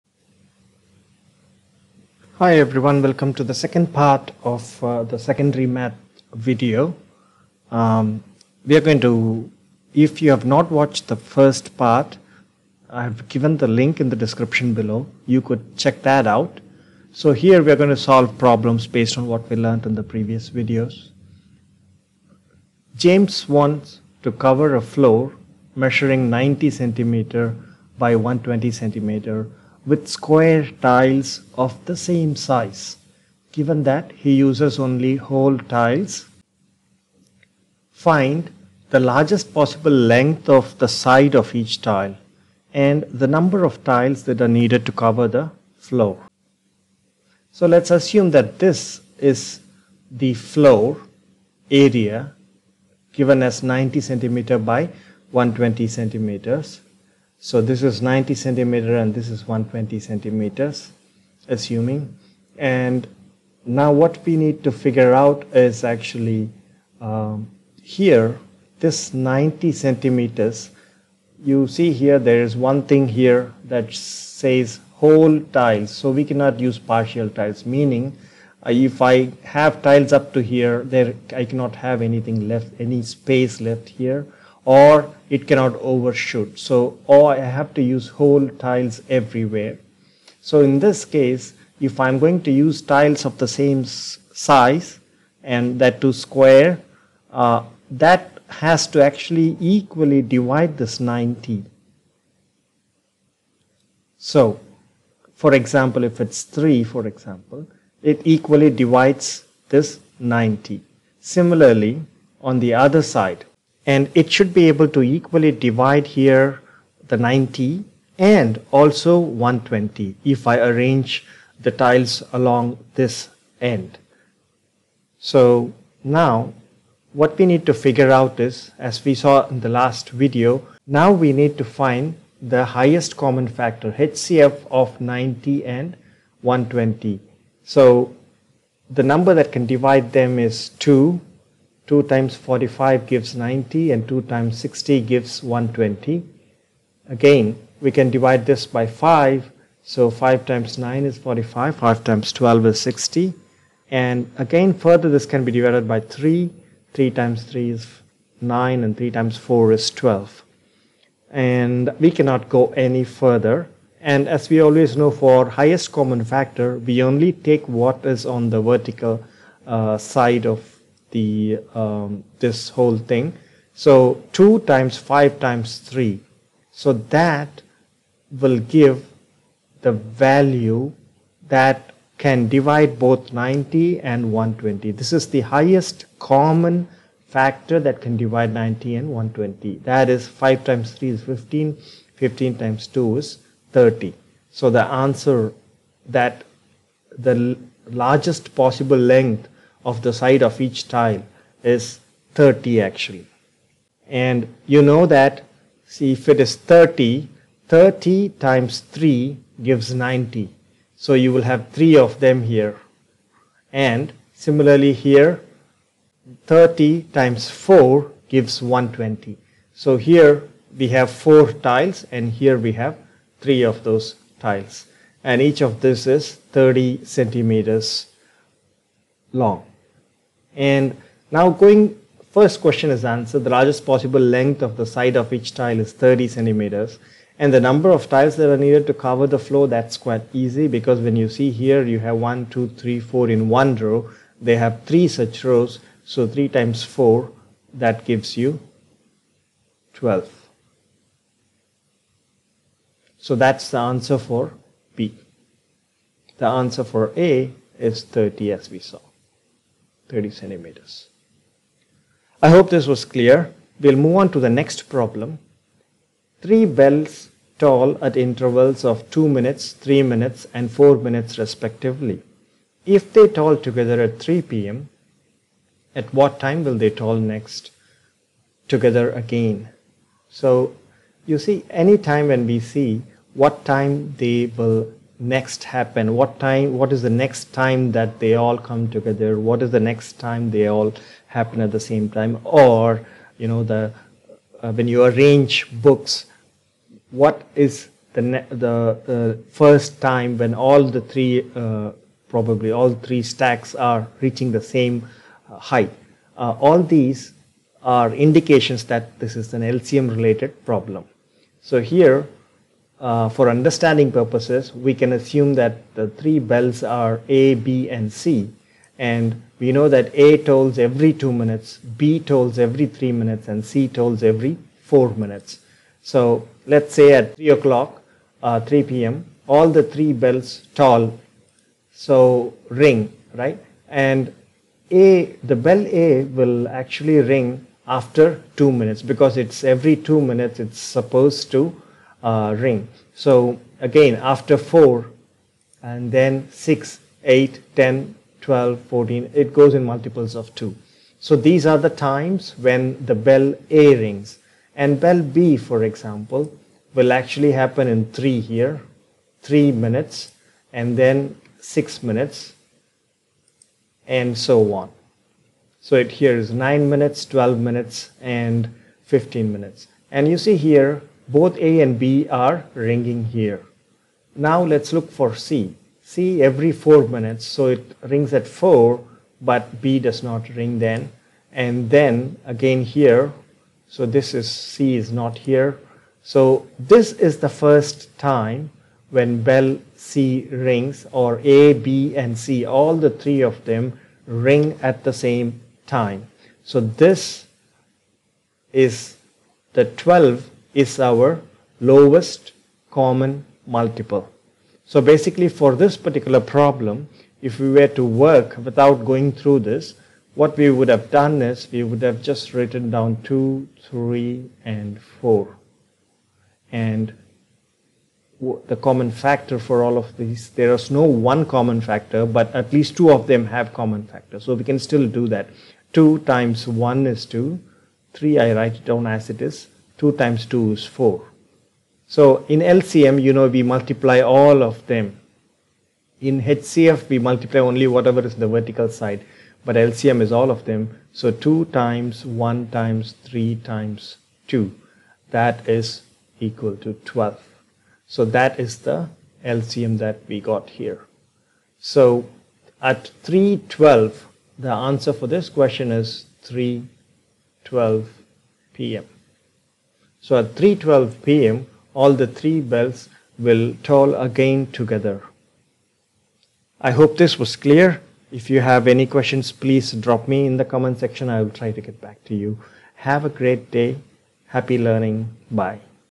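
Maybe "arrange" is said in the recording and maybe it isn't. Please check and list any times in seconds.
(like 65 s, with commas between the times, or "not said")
120 s, 295 s.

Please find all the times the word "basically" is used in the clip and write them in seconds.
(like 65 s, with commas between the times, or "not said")
405 s.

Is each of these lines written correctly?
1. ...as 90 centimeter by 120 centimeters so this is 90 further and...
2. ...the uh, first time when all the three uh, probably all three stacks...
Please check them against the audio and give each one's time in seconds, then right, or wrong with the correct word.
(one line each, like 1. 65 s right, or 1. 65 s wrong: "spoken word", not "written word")
1. 53 s wrong: "centimeter", not "further"
2. 298 s right.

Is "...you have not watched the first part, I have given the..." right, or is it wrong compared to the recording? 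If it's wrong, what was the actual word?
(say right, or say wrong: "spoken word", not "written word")
right.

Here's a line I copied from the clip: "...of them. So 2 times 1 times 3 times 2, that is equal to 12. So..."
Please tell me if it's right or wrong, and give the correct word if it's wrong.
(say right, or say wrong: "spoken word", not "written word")
right.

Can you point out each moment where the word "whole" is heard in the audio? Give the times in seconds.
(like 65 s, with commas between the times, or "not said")
35 s, 74 s, 88 s, 172 s.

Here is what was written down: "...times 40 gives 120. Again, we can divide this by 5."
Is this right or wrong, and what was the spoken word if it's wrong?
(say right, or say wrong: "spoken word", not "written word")
wrong: "60", not "40".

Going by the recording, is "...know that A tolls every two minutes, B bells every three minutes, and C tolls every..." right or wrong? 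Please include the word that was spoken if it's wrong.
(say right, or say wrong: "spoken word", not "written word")
wrong: "tolls", not "bells".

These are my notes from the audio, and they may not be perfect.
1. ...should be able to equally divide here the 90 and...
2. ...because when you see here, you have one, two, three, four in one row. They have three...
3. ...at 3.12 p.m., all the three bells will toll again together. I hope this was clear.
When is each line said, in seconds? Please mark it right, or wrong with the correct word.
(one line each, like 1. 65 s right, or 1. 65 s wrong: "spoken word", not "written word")
1. 114 s right
2. 240 s right
3. 460 s right.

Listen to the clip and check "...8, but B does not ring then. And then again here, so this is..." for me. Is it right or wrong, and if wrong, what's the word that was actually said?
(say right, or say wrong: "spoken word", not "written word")
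wrong: "4", not "8".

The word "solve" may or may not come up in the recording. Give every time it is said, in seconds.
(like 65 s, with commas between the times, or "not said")
18 s.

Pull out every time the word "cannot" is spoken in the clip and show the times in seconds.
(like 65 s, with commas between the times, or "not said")
76 s, 81 s, 85 s, 162 s.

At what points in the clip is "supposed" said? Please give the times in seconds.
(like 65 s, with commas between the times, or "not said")
340 s.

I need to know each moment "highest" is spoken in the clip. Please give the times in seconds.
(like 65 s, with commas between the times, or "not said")
132 s, 165 s, 185 s.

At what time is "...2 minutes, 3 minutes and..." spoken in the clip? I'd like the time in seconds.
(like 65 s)
269 s.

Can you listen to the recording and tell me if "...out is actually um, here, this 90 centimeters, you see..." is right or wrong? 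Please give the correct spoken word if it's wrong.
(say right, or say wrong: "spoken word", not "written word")
right.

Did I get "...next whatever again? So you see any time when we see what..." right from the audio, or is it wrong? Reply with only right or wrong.
wrong.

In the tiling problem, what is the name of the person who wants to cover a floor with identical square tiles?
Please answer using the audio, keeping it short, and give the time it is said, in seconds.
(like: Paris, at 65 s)
James, at 22 s.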